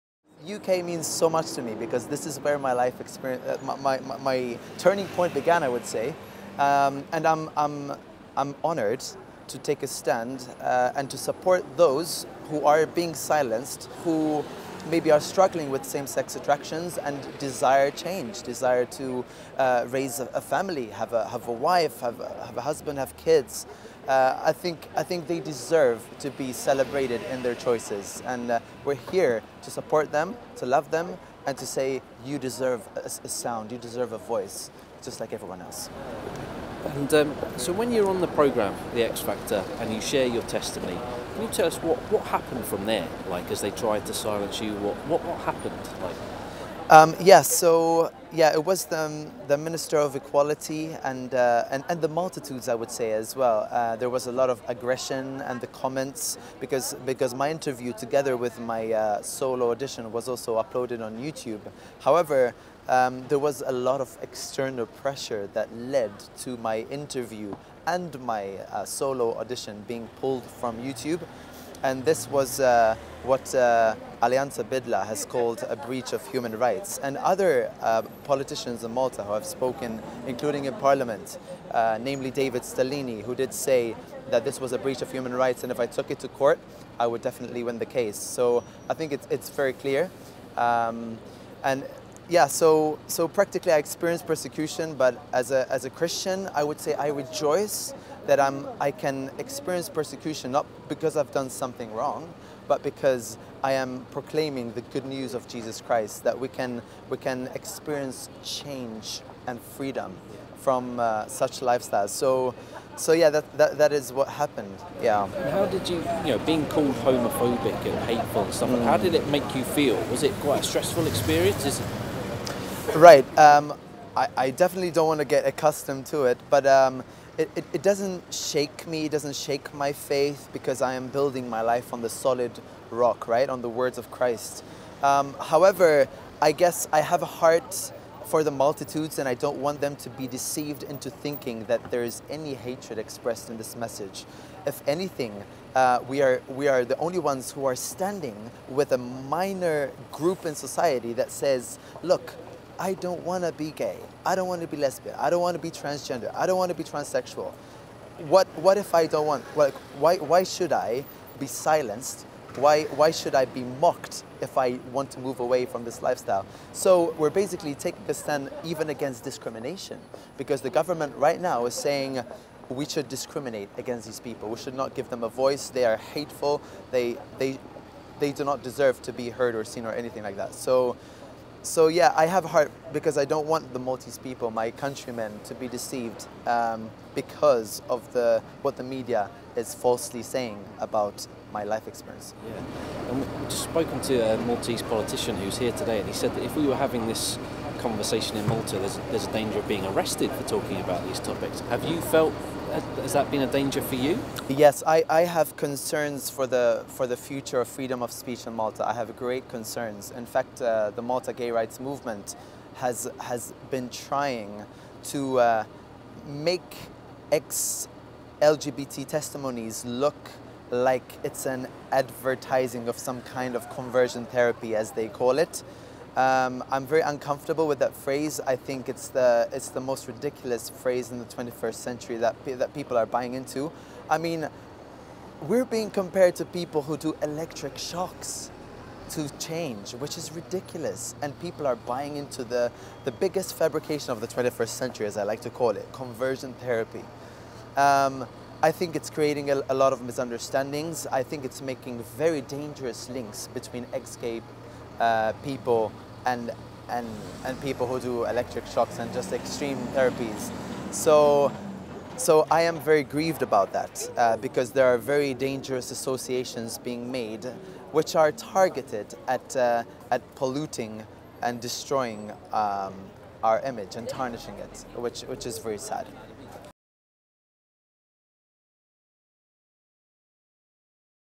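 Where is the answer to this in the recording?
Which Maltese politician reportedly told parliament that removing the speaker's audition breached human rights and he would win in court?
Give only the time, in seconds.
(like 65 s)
82 s.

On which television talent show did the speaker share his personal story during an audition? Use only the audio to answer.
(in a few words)
The X Factor.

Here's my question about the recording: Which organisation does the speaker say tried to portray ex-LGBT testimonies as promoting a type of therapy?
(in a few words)
Malta gay rights movement.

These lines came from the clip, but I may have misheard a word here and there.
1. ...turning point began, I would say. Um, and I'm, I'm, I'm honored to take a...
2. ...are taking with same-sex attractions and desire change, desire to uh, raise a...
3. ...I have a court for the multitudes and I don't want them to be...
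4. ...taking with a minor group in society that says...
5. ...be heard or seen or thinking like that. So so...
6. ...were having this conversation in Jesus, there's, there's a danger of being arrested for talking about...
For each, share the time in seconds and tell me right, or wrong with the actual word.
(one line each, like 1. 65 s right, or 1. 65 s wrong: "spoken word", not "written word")
1. 4 s right
2. 15 s wrong: "struggling", not "taking"
3. 136 s wrong: "heart", not "court"
4. 147 s wrong: "standing", not "taking"
5. 179 s wrong: "anything", not "thinking"
6. 196 s wrong: "Malta", not "Jesus".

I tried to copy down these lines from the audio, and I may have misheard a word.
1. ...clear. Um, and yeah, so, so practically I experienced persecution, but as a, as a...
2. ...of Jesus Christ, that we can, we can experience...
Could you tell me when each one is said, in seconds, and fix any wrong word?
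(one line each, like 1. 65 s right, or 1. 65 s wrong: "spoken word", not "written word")
1. 89 s right
2. 105 s right.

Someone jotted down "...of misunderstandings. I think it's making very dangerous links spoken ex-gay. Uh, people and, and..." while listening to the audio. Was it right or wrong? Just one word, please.
wrong.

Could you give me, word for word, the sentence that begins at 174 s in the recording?
We should not give them a voice.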